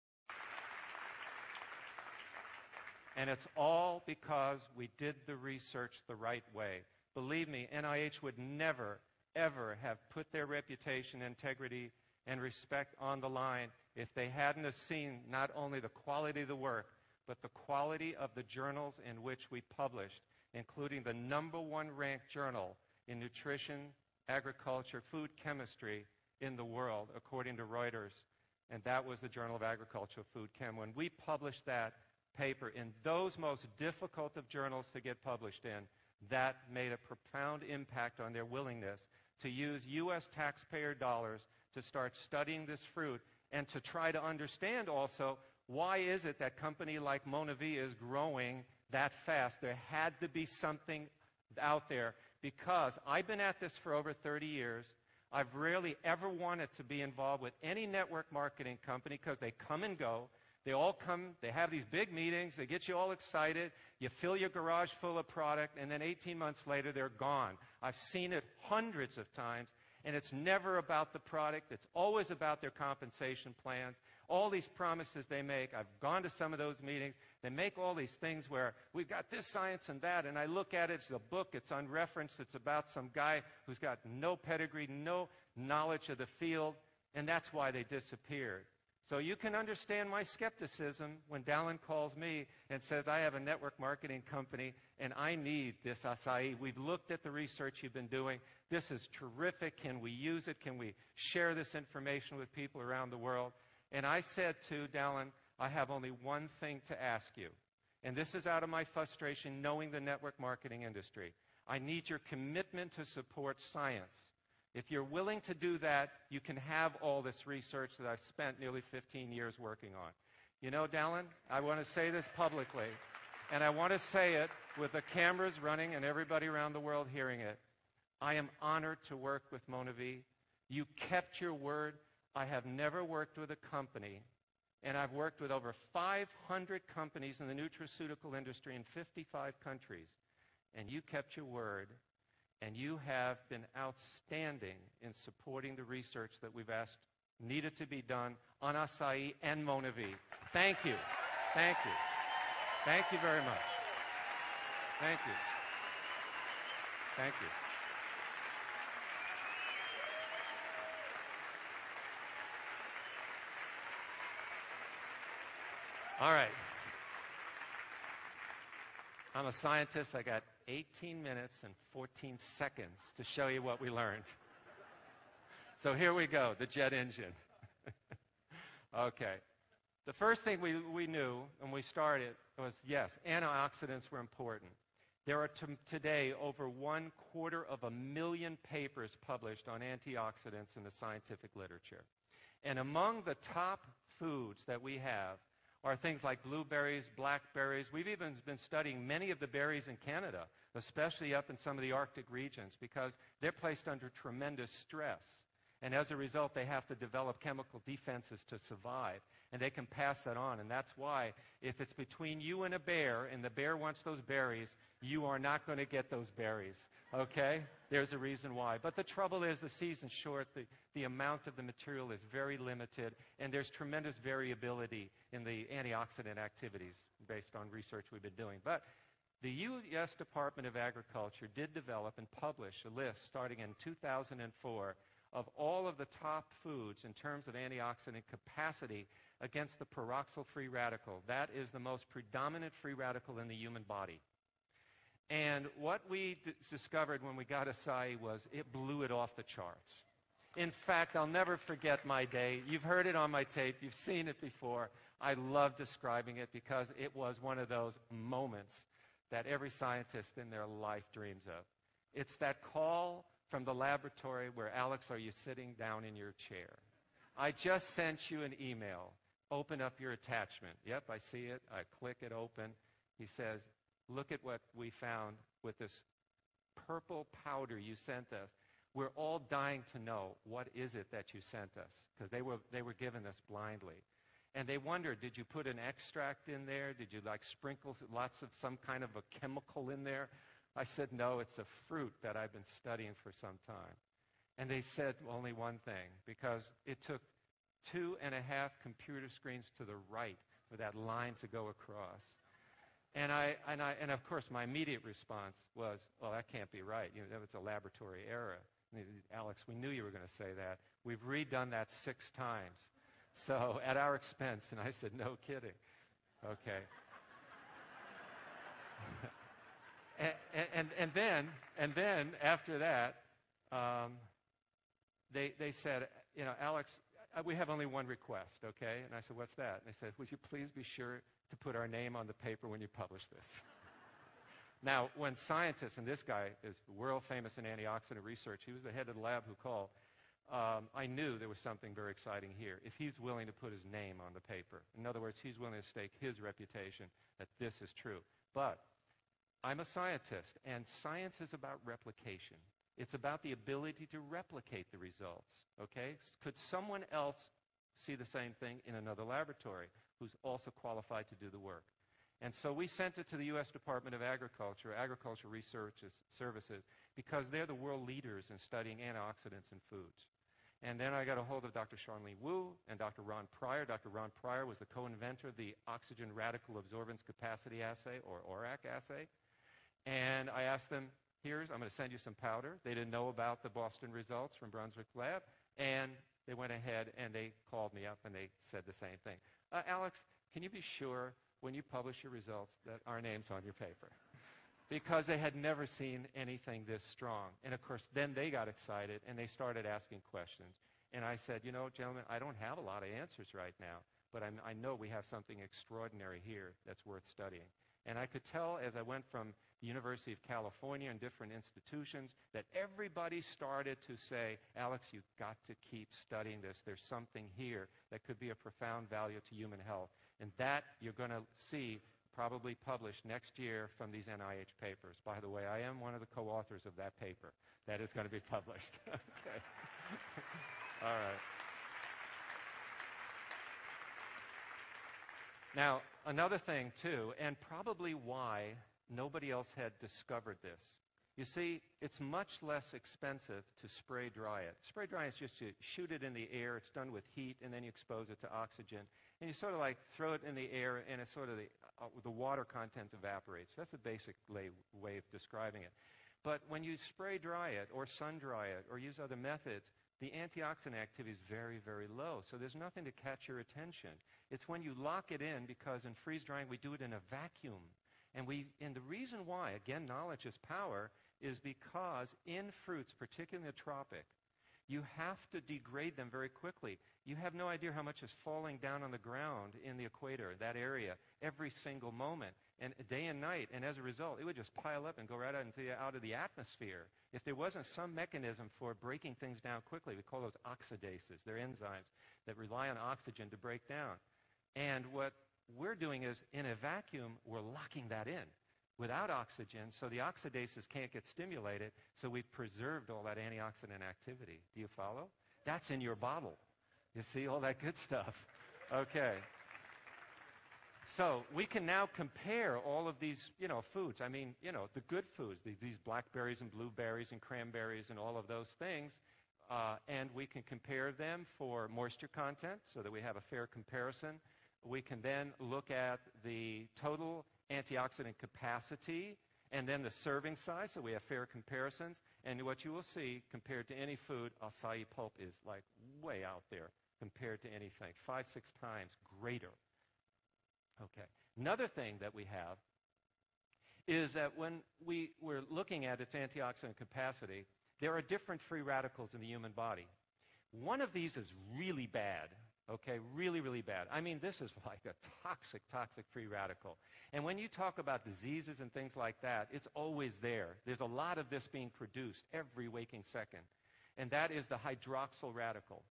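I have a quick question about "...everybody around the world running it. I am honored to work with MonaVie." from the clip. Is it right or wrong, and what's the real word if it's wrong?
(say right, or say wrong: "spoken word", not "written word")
wrong: "hearing", not "running".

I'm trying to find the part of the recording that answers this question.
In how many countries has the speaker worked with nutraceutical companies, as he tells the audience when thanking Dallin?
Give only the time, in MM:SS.
02:18.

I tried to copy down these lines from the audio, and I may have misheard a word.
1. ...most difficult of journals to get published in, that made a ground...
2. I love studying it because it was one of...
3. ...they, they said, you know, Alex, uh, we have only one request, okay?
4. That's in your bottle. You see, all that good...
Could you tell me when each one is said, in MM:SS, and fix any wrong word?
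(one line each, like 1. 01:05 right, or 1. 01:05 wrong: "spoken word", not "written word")
1. 00:33 wrong: "profound", not "ground"
2. 04:15 wrong: "describing", not "studying"
3. 05:25 right
4. 08:25 right.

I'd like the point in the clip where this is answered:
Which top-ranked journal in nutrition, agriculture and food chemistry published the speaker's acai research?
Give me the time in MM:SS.
00:29.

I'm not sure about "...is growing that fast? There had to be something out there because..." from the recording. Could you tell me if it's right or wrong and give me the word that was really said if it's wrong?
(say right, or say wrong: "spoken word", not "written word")
right.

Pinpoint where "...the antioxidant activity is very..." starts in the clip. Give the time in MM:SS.
07:40.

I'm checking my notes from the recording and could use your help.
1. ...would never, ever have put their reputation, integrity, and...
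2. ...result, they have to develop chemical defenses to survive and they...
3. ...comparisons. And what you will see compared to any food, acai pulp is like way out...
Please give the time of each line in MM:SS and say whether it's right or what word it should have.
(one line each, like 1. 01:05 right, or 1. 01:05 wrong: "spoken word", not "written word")
1. 00:08 right
2. 03:26 right
3. 08:51 right.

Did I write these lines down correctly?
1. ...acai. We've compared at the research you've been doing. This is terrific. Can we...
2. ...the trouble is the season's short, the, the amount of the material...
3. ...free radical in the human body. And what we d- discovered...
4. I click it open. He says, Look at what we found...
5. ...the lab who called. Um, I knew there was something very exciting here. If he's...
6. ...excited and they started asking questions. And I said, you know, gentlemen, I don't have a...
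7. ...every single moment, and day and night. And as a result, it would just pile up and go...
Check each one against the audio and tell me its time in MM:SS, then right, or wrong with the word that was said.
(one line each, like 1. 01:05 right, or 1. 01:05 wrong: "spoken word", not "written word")
1. 01:36 wrong: "looked", not "compared"
2. 03:38 right
3. 04:02 right
4. 04:31 right
5. 05:39 right
6. 06:38 right
7. 08:01 right.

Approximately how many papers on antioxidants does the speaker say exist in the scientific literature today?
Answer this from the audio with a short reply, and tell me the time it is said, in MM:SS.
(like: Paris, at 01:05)
over one quarter of a million, at 03:06.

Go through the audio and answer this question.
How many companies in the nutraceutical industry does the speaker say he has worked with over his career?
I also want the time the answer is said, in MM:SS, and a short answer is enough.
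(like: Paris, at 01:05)
over 500, at 02:15.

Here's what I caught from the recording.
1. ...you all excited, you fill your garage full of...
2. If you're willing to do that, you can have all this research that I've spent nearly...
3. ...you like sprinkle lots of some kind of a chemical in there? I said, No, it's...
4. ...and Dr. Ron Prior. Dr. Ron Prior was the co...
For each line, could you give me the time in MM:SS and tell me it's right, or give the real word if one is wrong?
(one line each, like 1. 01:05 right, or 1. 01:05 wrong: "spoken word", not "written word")
1. 01:02 right
2. 01:54 right
3. 04:47 right
4. 06:12 right.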